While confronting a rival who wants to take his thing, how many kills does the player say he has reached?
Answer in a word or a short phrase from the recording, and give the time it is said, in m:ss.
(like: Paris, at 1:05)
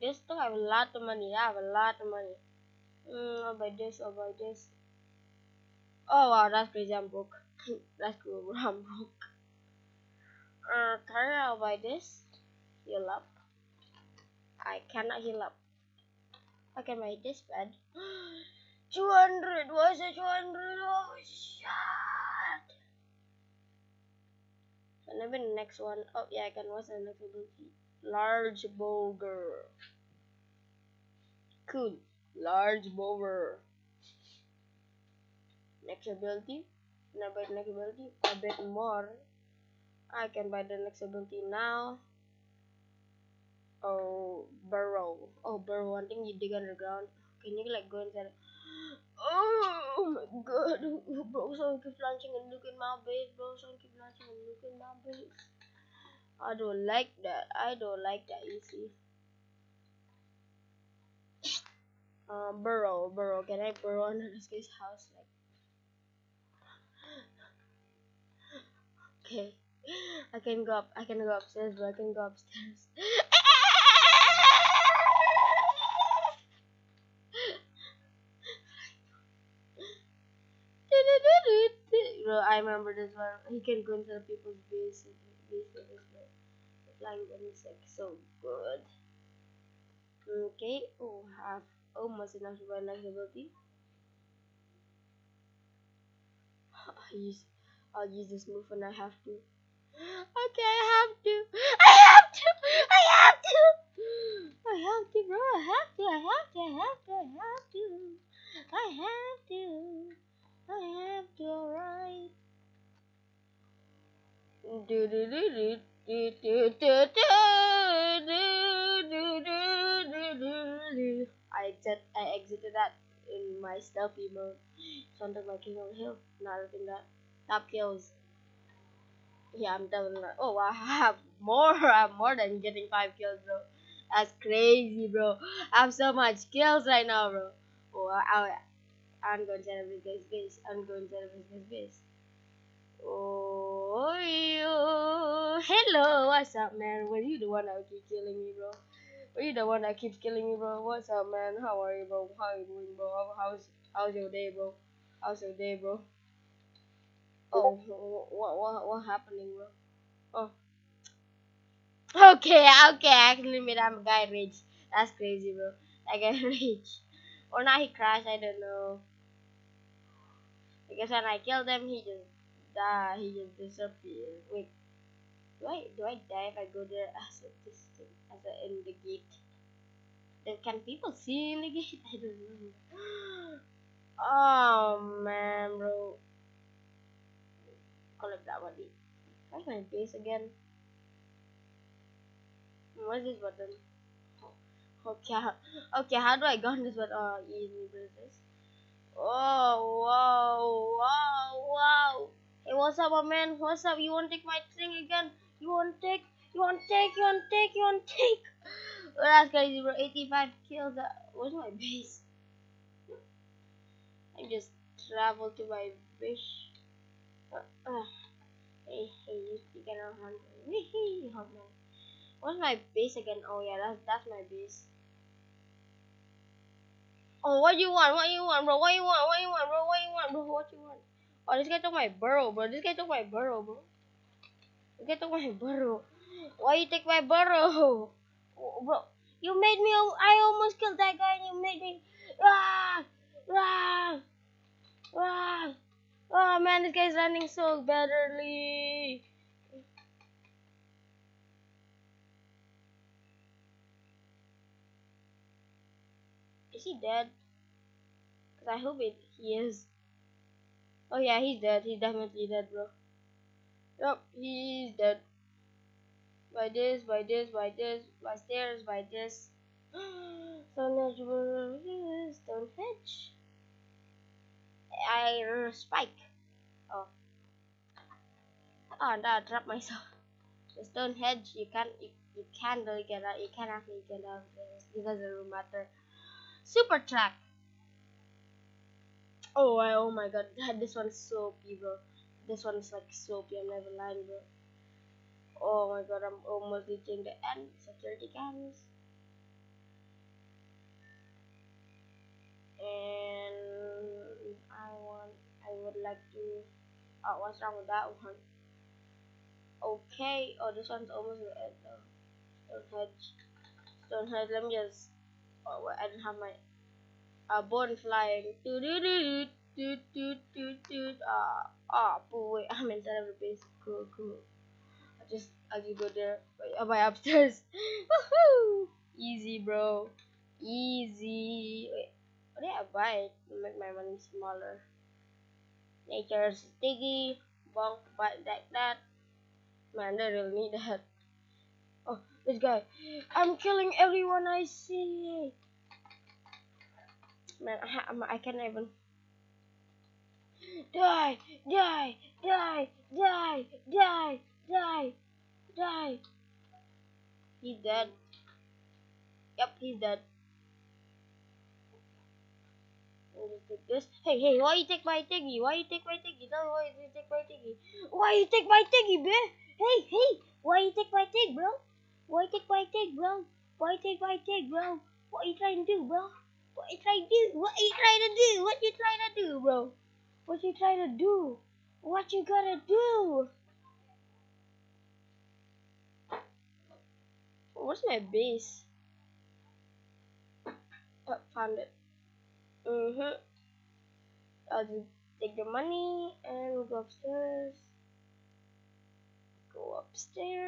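85, at 3:29.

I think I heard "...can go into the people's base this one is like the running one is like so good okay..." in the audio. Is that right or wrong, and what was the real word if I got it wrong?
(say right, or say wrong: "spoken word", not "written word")
wrong: "flying", not "running".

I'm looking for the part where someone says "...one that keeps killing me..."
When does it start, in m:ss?
2:29.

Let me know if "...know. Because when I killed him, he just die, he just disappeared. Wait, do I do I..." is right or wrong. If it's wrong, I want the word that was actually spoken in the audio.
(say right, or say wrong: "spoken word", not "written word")
right.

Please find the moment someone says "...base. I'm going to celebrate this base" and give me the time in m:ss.
2:20.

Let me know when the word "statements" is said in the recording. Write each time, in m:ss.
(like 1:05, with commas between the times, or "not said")
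not said.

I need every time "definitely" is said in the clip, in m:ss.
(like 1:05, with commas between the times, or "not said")
2:09, 4:21.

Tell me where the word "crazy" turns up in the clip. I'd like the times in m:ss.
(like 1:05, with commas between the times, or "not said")
0:06, 2:14, 2:45, 3:29.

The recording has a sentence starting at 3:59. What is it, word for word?
I almost killed that guy and you made me...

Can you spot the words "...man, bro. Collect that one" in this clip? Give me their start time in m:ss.
3:05.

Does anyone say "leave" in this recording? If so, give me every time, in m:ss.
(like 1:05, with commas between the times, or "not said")
not said.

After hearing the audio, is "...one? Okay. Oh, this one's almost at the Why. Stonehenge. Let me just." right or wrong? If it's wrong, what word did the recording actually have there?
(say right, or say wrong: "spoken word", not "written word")
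wrong: "Stonehenge", not "Why".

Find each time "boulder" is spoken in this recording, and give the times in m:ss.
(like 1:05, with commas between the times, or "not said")
0:28, 0:32.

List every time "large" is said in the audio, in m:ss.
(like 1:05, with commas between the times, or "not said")
0:28, 0:32.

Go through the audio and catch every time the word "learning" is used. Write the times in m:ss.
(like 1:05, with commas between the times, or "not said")
not said.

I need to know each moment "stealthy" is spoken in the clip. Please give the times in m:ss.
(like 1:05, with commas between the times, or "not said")
2:03.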